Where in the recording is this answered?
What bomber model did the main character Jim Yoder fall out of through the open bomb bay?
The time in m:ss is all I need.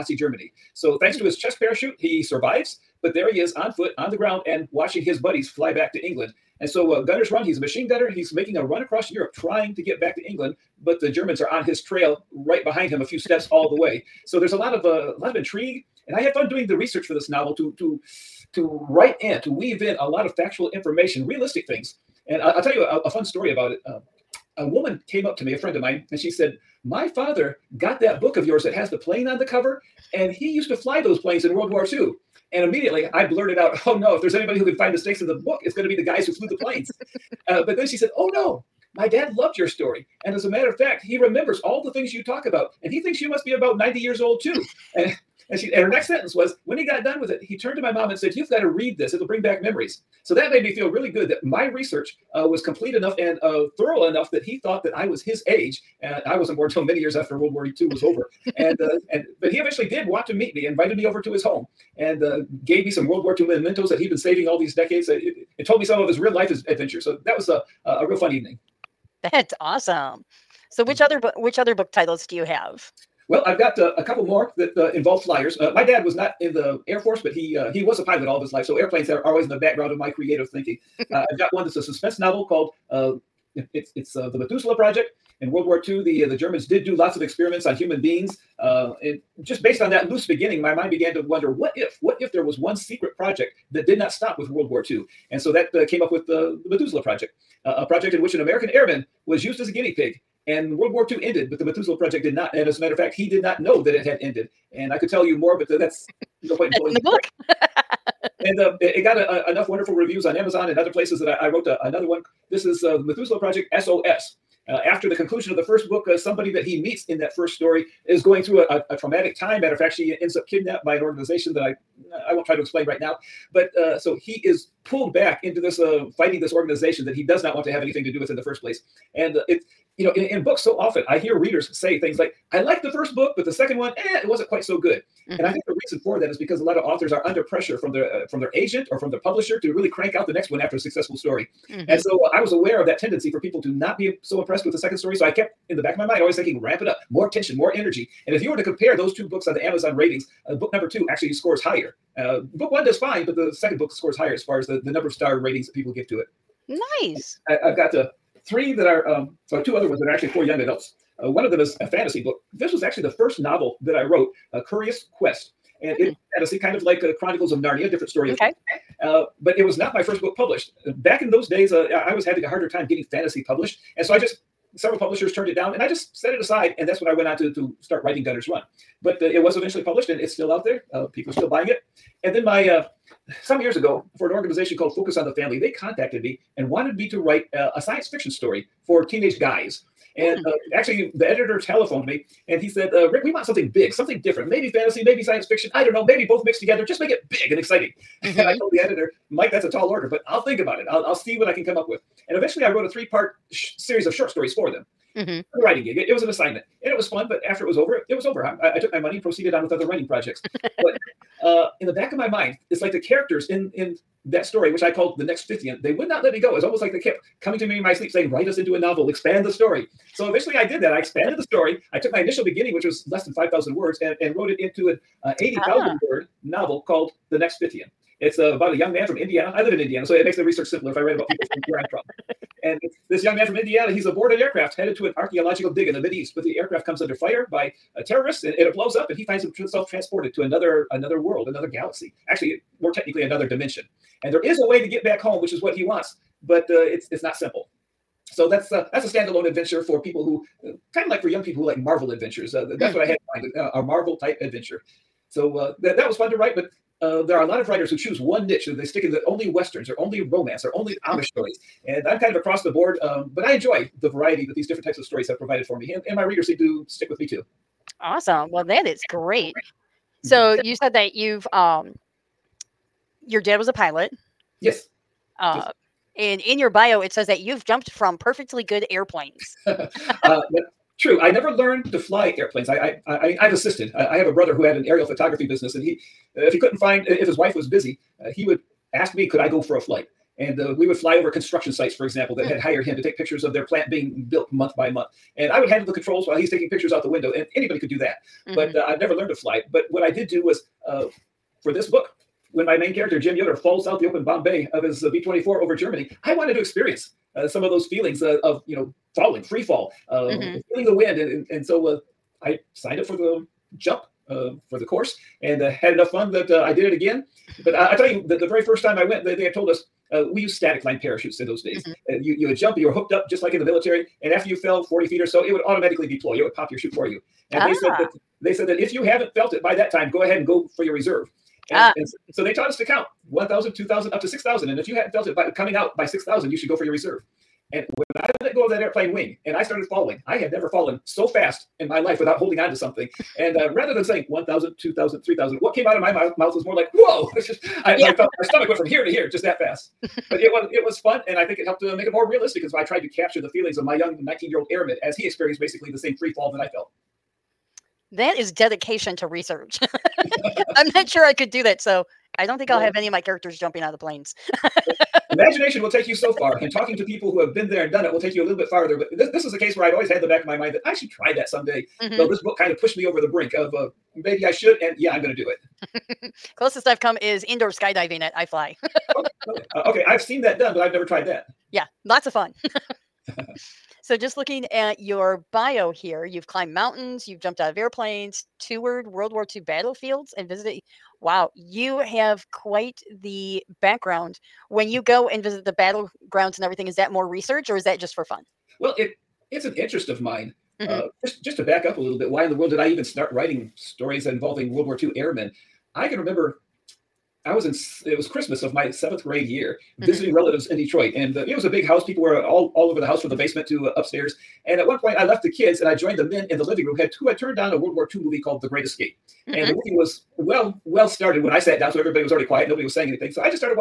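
5:05.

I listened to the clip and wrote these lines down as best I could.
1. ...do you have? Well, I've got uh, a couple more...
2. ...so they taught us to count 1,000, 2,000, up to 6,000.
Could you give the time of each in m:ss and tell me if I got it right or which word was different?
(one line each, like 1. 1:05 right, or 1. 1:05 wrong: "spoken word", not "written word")
1. 1:12 right
2. 5:32 right.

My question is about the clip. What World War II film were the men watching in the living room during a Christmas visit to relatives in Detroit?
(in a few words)
The Great Escape.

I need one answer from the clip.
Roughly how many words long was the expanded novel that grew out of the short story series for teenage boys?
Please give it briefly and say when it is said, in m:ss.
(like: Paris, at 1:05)
80,000, at 3:45.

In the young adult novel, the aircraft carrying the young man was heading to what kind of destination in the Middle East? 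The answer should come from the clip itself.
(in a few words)
archaeological dig.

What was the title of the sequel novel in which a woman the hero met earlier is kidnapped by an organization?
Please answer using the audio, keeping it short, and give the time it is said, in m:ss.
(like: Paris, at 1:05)
The Methuselah Project SOS, at 1:52.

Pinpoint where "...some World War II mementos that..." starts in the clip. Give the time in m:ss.
1:02.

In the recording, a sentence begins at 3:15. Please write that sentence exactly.
I don't know, maybe both mixed together.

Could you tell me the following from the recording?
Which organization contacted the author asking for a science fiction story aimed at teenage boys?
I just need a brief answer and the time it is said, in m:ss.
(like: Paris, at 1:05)
Focus on the Family, at 3:04.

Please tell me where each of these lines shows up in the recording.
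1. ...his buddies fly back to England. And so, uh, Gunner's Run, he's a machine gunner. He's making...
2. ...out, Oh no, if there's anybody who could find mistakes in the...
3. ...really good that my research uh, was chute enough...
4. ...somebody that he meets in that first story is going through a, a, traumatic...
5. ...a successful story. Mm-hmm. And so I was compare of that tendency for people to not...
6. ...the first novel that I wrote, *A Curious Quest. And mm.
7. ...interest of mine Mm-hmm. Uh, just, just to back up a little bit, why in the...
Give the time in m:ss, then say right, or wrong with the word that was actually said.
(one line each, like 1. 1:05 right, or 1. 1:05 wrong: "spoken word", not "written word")
1. 0:05 right
2. 0:33 right
3. 0:50 wrong: "complete", not "chute"
4. 1:56 right
5. 2:20 wrong: "aware", not "compare"
6. 2:43 right
7. 6:39 right.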